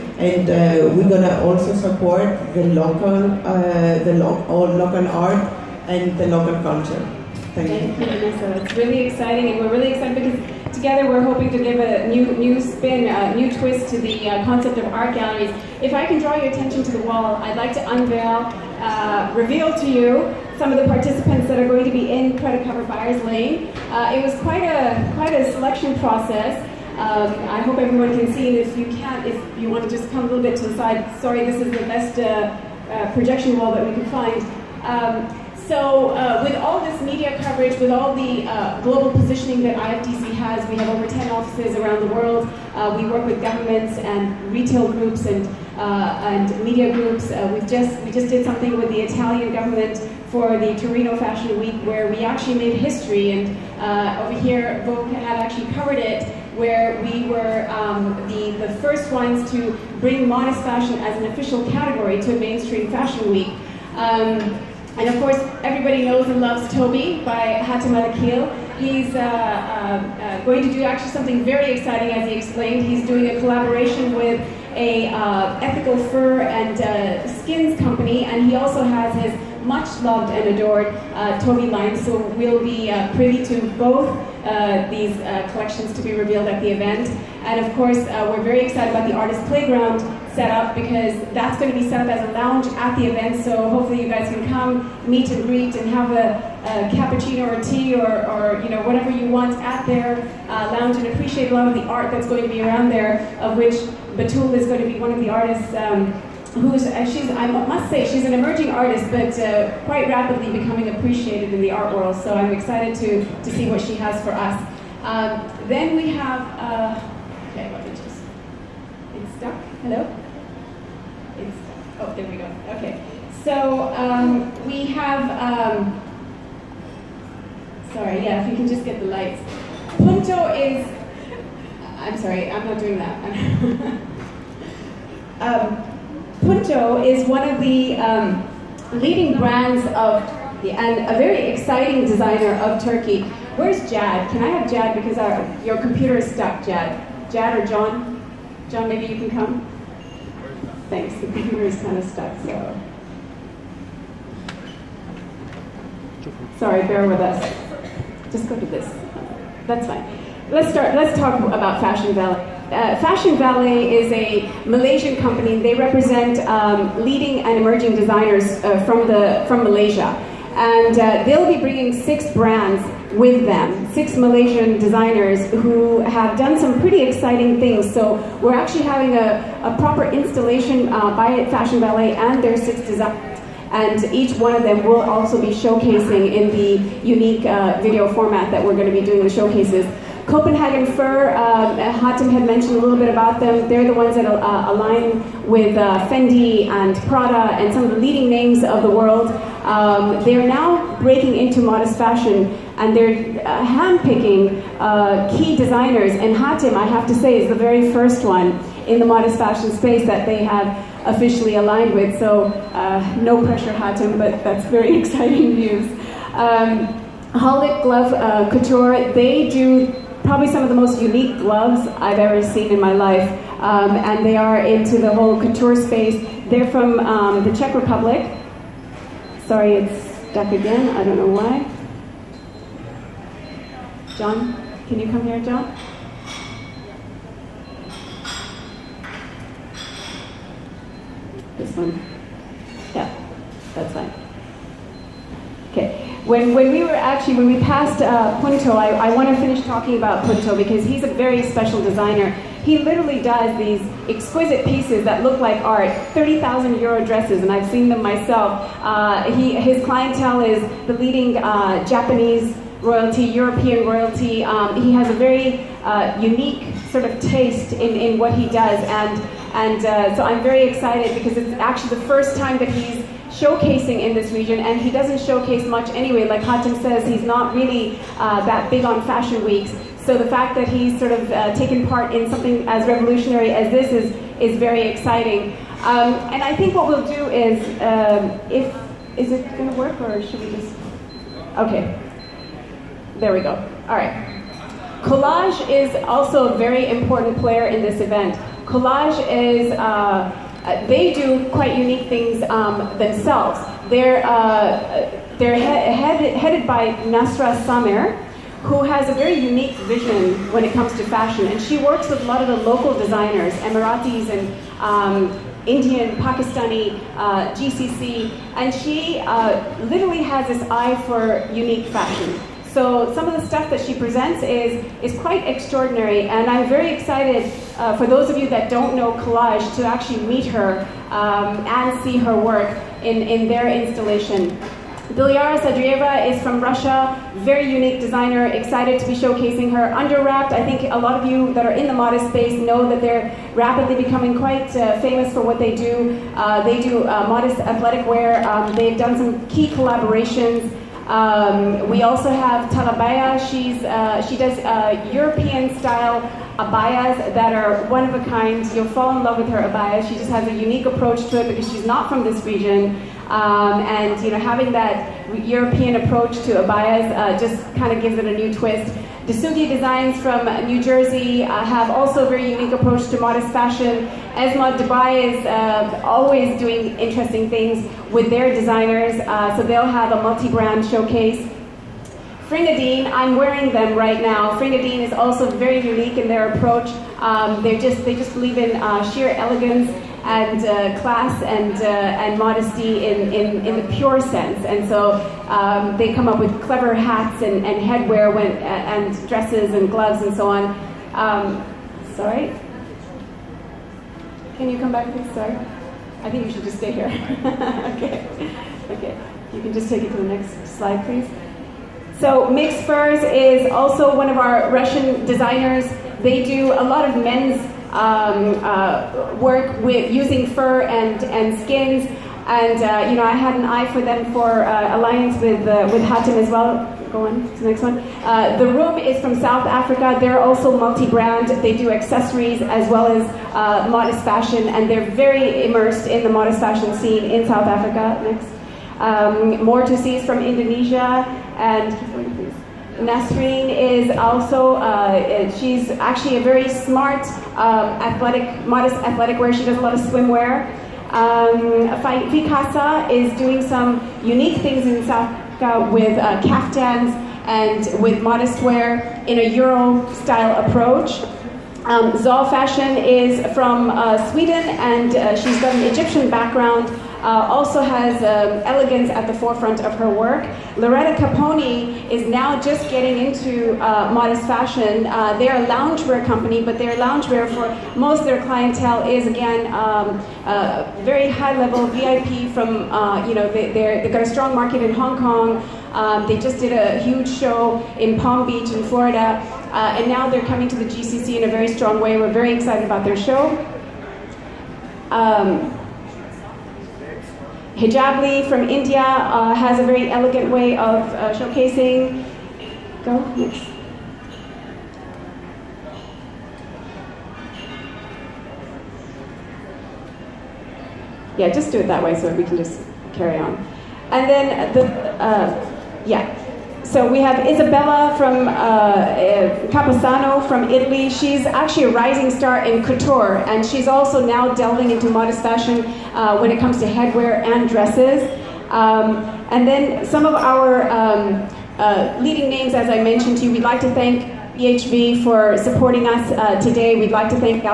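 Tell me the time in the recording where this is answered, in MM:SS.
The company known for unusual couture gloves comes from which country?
03:47.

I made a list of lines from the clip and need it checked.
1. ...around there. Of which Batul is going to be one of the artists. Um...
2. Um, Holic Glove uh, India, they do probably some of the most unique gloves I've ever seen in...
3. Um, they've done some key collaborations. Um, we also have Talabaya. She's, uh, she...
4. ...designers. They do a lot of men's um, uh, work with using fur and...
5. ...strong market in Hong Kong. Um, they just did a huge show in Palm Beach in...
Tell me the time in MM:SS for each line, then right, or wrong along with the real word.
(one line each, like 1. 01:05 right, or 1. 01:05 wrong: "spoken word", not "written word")
1. 01:42 right
2. 03:36 wrong: "Couture", not "India"
3. 05:48 right
4. 06:55 right
5. 08:04 right.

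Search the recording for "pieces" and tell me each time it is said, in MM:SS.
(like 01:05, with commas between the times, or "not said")
04:14.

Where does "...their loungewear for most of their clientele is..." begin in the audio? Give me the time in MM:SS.
07:56.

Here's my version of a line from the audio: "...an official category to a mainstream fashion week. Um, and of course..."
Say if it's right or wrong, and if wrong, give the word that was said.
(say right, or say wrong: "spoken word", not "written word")
right.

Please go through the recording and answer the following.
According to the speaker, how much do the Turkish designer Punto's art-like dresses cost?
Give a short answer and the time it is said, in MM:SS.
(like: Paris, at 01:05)
30,000 euros, at 04:16.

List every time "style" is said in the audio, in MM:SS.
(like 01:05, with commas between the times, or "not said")
05:55, 07:39.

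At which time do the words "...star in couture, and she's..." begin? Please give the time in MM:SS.
08:42.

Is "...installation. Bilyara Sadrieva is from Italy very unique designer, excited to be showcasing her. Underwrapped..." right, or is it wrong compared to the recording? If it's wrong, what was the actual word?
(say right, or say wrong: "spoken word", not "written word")
wrong: "Russia", not "Italy".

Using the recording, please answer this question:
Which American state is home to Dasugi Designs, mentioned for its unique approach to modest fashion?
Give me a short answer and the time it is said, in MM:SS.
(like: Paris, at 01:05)
New Jersey, at 06:10.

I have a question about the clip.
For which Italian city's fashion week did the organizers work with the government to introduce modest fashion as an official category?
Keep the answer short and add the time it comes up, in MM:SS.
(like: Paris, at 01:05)
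Torino, at 00:50.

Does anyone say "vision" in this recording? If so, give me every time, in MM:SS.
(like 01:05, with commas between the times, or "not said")
05:09.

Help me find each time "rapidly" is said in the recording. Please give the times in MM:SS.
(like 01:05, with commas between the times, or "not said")
01:50, 05:43.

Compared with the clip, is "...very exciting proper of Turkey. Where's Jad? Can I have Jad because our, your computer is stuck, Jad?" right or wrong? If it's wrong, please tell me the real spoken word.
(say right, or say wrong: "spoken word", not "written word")
wrong: "designer", not "proper".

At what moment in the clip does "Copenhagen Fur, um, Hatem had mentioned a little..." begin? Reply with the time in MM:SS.
03:10.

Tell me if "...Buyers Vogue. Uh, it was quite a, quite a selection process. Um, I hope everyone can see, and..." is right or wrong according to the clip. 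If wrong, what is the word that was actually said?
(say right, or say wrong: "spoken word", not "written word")
wrong: "Lane", not "Vogue".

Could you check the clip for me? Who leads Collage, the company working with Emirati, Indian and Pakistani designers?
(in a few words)
Nasra Samer.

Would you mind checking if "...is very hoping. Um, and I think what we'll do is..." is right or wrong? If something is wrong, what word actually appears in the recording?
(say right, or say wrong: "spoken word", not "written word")
wrong: "exciting", not "hoping".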